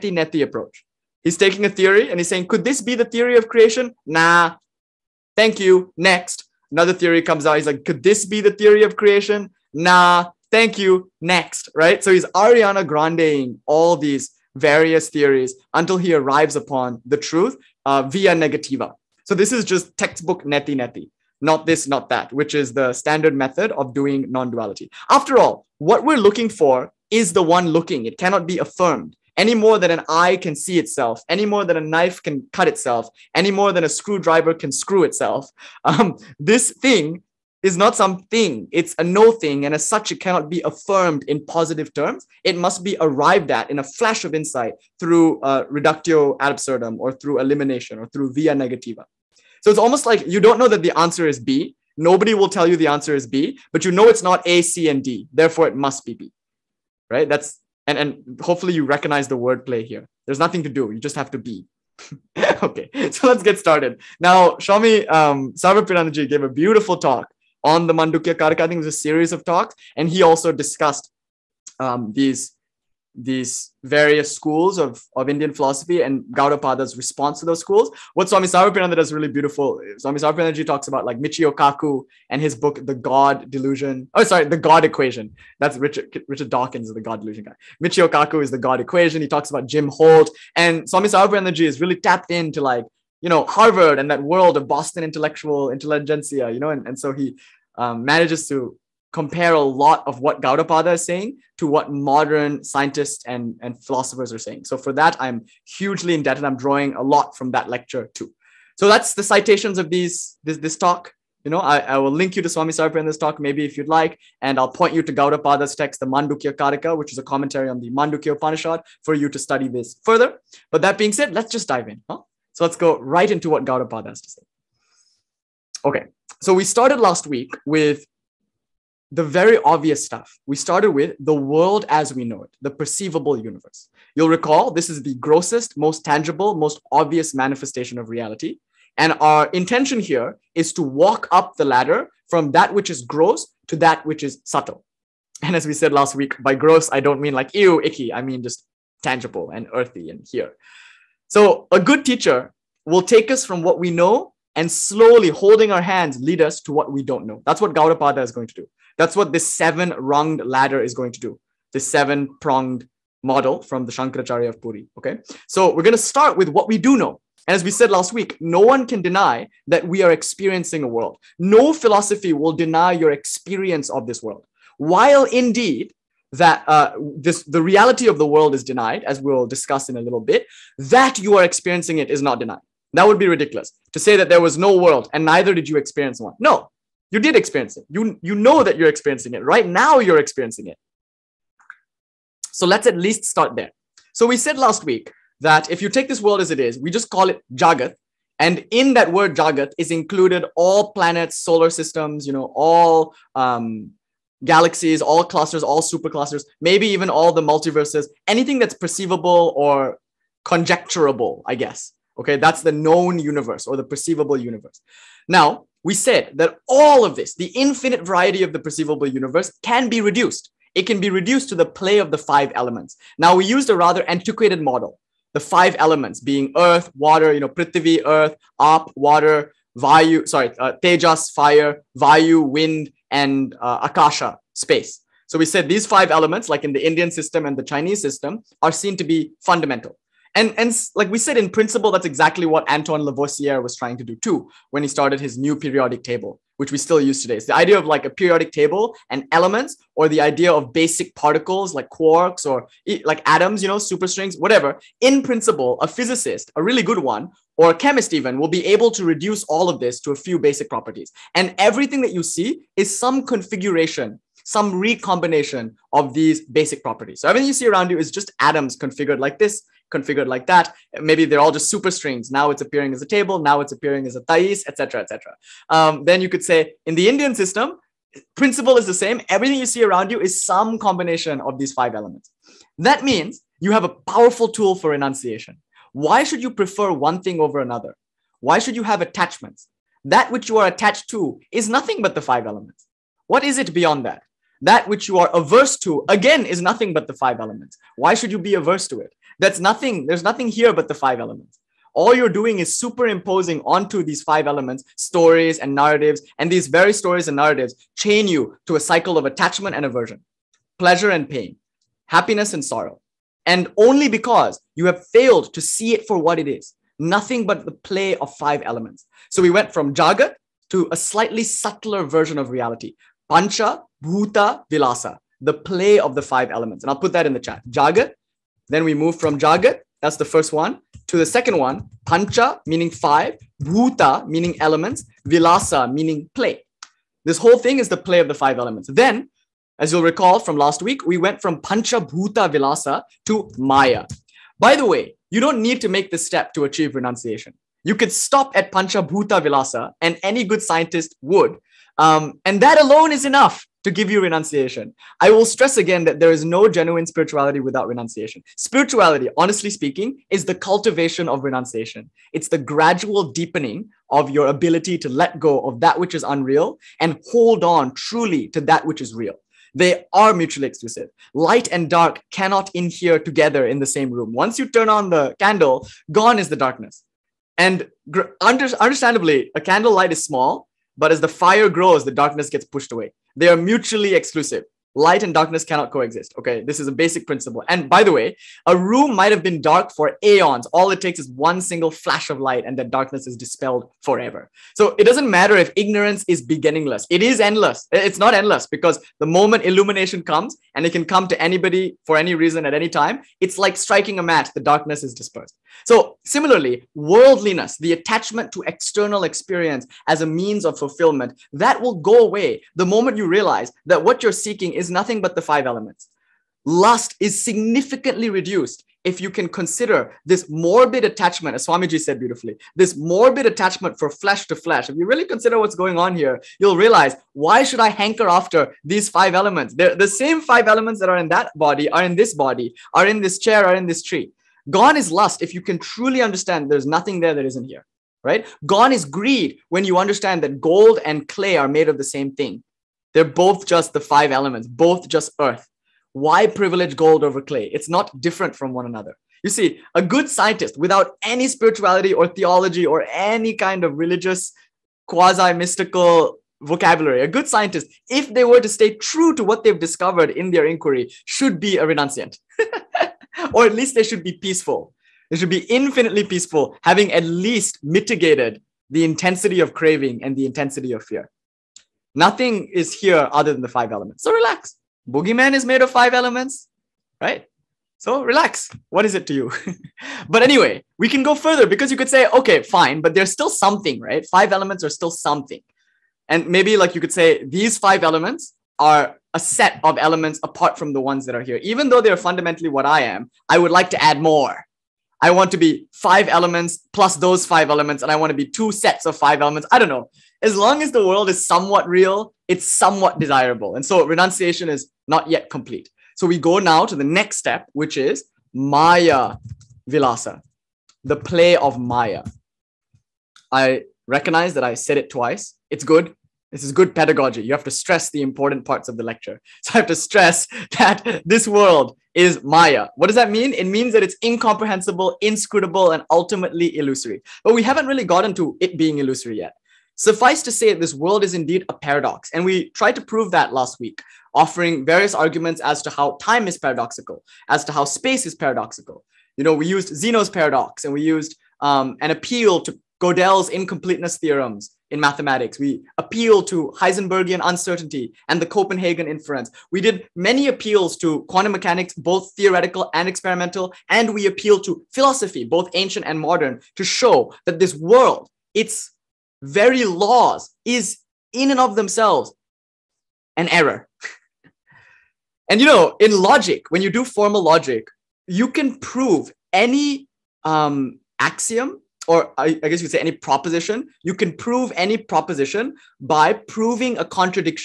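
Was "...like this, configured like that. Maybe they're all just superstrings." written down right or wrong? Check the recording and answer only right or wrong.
right.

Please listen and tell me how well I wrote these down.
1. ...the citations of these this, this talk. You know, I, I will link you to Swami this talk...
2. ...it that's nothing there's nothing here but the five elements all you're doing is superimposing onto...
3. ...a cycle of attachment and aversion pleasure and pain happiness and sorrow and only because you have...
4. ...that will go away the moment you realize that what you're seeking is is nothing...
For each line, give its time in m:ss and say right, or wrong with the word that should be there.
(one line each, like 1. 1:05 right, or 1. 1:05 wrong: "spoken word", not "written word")
1. 1:49 right
2. 4:59 right
3. 5:08 right
4. 6:51 right.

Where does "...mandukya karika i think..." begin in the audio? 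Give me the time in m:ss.
1:07.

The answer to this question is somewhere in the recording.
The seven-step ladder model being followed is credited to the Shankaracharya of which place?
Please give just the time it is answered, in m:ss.
2:44.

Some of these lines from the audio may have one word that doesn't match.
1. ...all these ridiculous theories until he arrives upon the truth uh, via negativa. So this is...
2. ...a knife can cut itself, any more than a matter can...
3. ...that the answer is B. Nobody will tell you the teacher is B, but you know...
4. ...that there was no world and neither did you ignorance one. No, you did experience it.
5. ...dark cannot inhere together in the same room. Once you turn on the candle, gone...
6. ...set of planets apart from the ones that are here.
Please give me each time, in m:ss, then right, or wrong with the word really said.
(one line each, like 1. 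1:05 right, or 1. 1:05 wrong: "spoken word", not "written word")
1. 0:13 wrong: "various", not "ridiculous"
2. 0:31 wrong: "screwdriver", not "matter"
3. 0:50 wrong: "answer", not "teacher"
4. 3:04 wrong: "experience", not "ignorance"
5. 6:11 right
6. 8:09 wrong: "elements", not "planets".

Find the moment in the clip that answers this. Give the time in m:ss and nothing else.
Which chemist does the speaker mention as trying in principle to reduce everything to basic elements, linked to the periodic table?
4:02.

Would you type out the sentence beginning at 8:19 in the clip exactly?
I don't know as long as the world is somewhat real, it's somewhat desirable.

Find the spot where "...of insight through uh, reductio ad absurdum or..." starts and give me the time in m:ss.
0:44.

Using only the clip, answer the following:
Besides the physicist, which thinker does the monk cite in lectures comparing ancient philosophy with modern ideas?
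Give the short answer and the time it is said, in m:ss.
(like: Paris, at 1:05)
Jim Holt, at 1:29.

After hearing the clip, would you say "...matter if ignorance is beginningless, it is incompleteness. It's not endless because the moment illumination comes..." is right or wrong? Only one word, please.
wrong.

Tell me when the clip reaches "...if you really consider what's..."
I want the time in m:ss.
7:04.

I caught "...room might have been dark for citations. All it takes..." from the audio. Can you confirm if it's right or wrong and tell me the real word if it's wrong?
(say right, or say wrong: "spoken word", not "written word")
wrong: "aeons", not "citations".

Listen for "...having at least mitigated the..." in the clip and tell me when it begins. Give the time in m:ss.
7:46.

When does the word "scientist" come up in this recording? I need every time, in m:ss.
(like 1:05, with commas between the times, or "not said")
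1:42, 5:50, 7:30, 7:37.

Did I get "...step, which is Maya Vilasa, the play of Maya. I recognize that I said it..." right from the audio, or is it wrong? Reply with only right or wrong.
right.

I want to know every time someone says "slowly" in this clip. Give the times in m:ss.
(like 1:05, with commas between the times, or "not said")
2:34.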